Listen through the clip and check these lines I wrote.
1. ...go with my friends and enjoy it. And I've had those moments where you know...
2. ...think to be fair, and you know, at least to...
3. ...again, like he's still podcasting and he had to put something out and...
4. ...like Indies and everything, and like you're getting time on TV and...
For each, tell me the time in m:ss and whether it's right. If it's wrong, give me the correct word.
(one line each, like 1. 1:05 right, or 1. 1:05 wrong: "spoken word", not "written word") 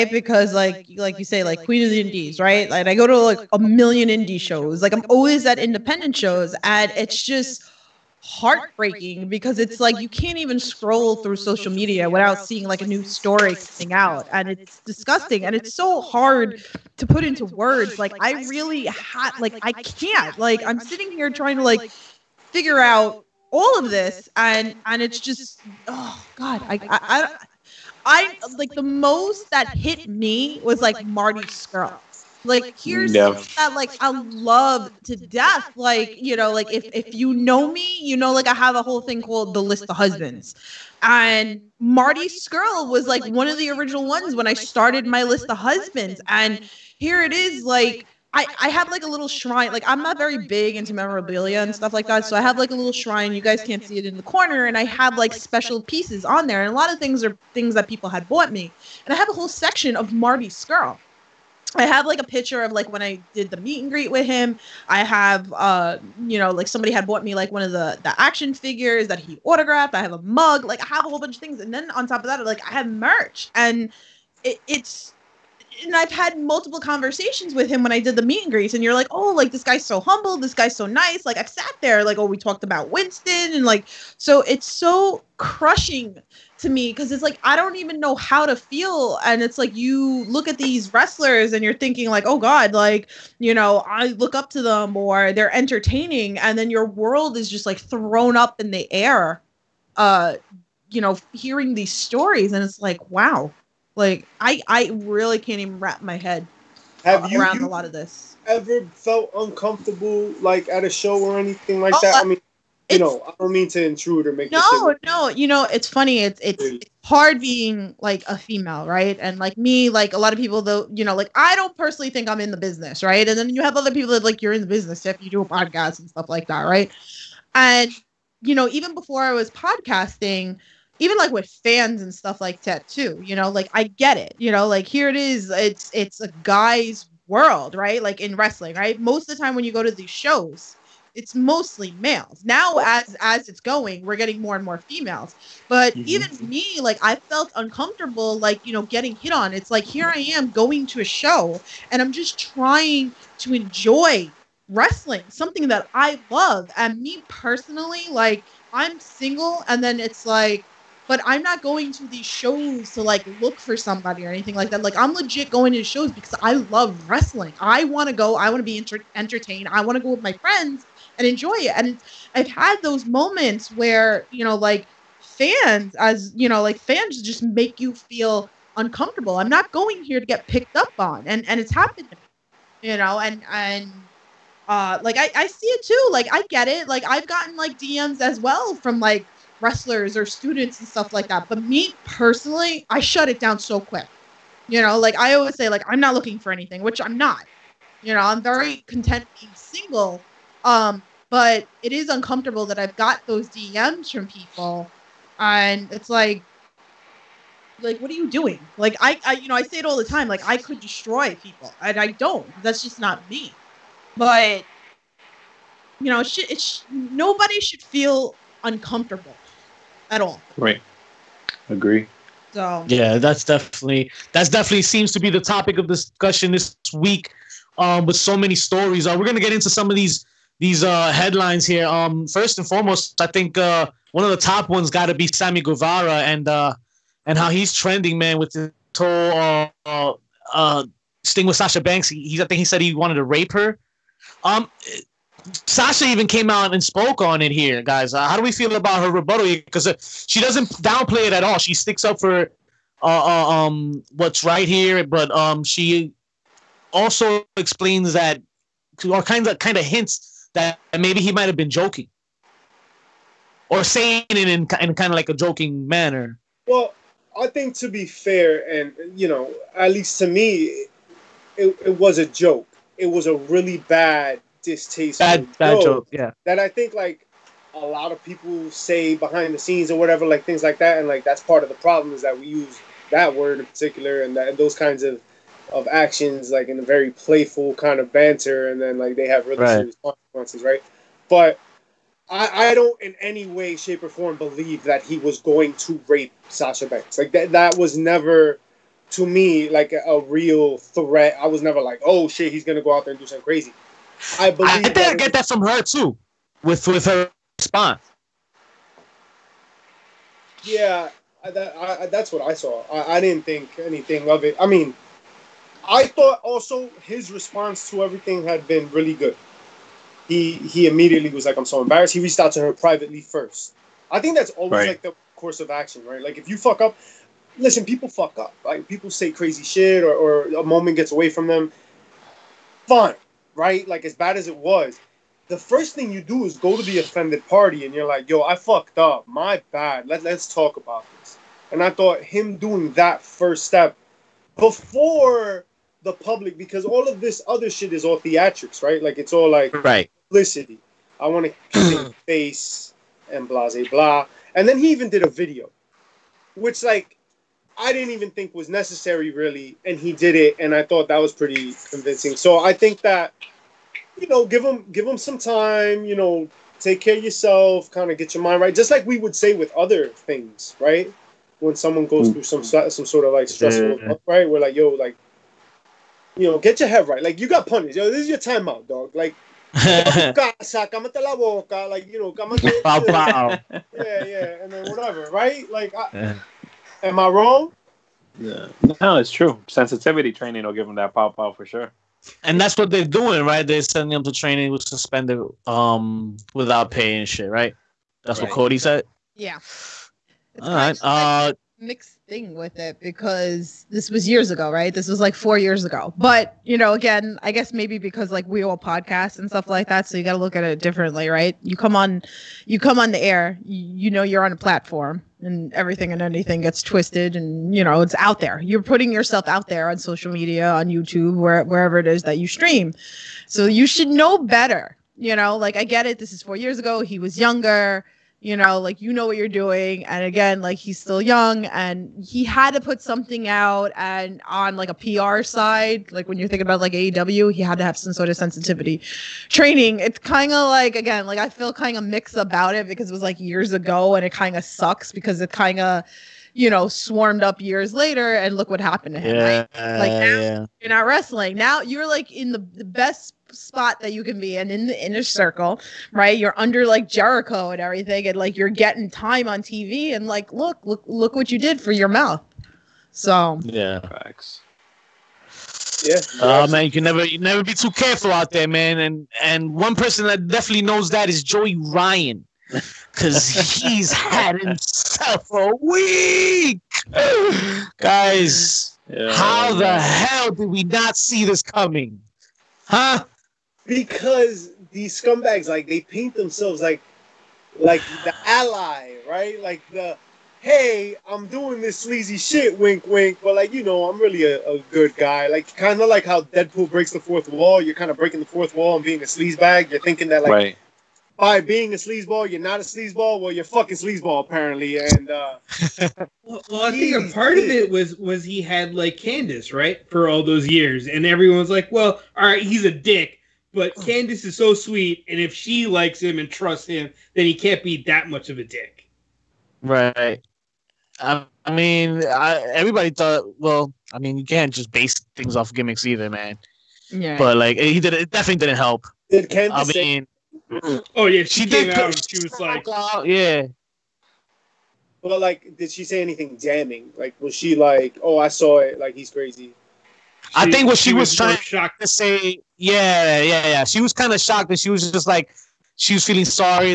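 1. 2:50 right
2. 4:27 right
3. 7:10 wrong: "young", not "podcasting"
4. 7:36 wrong: "Jericho", not "Indies".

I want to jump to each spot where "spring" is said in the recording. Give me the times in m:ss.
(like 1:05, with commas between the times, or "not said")
not said.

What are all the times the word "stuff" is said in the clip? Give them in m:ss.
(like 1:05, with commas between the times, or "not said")
0:51, 2:06, 2:12, 3:10, 6:49.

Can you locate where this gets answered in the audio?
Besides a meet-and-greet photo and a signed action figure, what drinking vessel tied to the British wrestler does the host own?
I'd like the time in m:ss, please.
1:10.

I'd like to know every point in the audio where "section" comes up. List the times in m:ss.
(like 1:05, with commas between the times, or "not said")
0:59.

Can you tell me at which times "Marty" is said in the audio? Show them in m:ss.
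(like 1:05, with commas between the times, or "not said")
0:31, 0:41, 1:00.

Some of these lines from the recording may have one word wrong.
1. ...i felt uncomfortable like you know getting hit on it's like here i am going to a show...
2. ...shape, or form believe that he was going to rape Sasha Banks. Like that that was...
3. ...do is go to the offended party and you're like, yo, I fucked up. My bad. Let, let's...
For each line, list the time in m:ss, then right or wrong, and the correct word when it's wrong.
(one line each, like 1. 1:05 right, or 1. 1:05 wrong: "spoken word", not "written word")
1. 2:27 right
2. 4:53 right
3. 5:36 right.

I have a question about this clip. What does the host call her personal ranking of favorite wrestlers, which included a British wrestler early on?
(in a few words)
the list of husbands.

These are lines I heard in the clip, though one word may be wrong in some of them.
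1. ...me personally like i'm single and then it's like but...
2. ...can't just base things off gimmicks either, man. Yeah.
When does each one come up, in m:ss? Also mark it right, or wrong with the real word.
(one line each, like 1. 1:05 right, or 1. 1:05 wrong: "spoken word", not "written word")
1. 2:37 right
2. 8:44 right.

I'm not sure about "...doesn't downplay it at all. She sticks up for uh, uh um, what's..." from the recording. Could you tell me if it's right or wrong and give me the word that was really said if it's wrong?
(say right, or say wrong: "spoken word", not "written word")
right.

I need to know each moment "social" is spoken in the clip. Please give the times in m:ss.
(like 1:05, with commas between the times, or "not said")
0:11, 6:59.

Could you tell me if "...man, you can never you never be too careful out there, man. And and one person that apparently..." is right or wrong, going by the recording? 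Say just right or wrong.
wrong.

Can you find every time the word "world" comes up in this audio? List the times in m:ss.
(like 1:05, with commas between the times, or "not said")
1:36, 2:17.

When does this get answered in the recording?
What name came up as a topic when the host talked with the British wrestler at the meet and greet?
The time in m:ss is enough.
1:22.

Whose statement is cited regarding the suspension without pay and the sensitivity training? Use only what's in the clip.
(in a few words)
Cody.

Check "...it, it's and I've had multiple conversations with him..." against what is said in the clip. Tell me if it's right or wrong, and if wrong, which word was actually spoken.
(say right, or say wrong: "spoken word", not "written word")
right.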